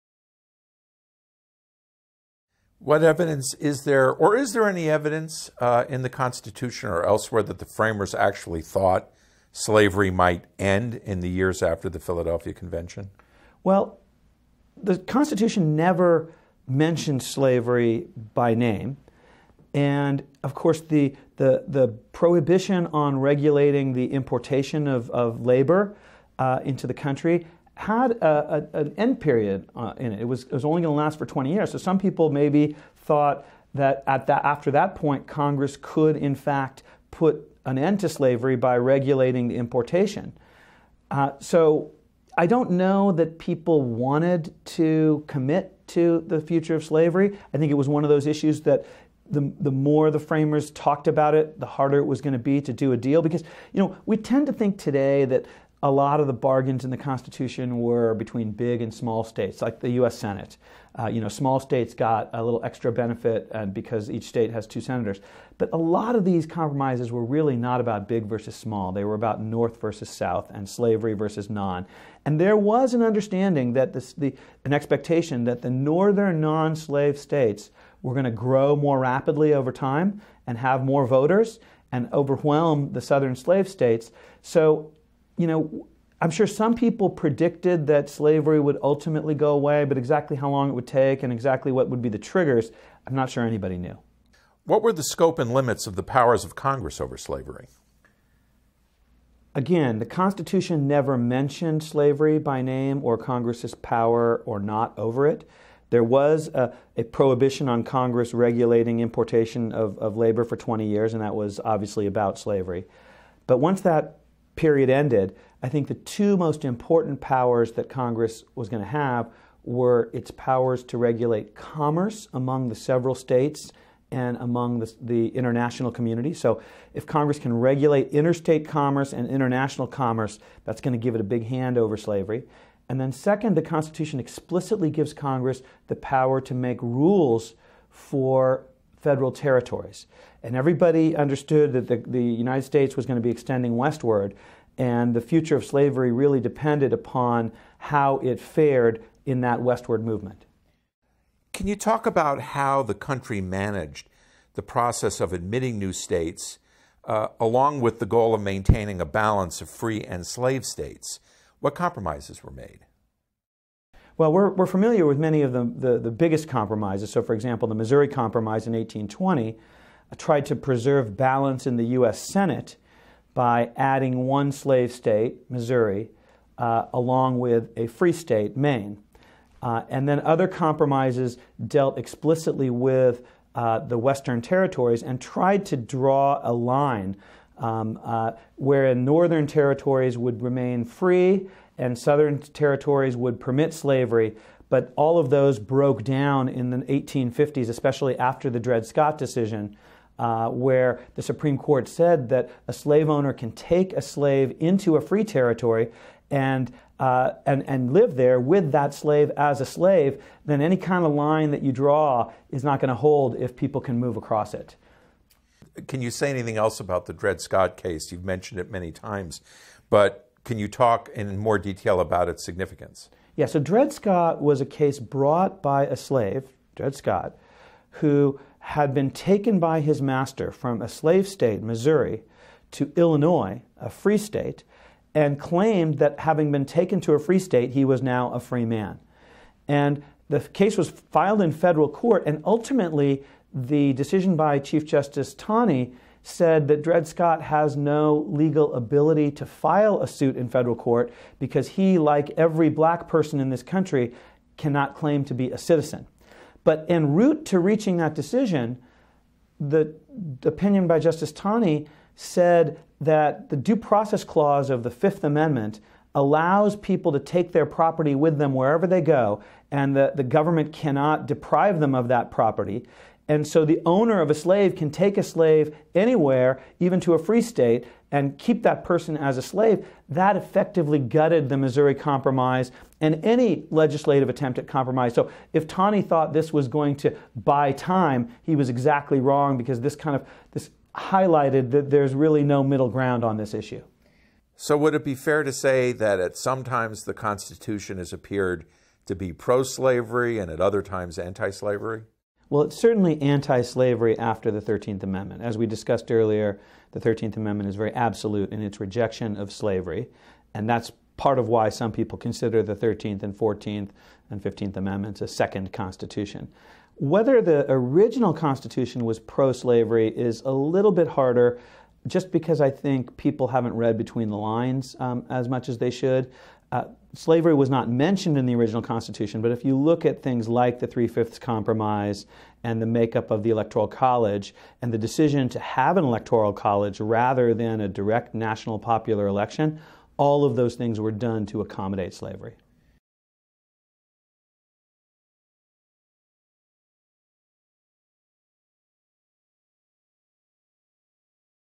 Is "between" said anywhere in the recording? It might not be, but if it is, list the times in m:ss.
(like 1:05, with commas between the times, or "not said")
0:58, 5:23.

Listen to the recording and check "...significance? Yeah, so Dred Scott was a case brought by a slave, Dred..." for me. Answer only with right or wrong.
right.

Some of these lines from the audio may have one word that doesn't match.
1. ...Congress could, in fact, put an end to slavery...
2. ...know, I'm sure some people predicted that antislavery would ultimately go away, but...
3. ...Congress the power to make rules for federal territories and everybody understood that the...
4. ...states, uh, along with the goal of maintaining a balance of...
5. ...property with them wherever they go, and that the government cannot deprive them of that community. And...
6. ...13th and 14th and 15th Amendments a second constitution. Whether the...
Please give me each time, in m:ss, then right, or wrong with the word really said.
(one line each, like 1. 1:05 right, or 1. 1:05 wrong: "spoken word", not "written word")
1. 0:35 right
2. 1:25 wrong: "slavery", not "antislavery"
3. 2:15 right
4. 2:35 right
5. 4:27 wrong: "property", not "community"
6. 5:12 right.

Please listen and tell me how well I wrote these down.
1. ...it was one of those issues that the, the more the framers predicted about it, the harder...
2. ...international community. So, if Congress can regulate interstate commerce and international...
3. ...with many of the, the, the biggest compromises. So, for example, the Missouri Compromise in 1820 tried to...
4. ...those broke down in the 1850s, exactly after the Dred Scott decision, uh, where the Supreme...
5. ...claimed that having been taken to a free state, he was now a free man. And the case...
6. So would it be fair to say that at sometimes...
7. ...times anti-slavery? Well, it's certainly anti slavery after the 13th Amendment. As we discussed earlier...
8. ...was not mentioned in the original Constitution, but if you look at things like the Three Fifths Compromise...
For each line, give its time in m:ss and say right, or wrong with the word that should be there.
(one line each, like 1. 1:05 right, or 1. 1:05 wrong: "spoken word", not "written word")
1. 0:47 wrong: "talked", not "predicted"
2. 2:05 right
3. 2:45 right
4. 3:15 wrong: "especially", not "exactly"
5. 3:55 right
6. 4:54 right
7. 5:00 right
8. 5:27 right.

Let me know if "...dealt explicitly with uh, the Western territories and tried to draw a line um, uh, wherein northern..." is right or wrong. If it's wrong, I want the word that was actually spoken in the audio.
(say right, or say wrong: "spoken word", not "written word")
right.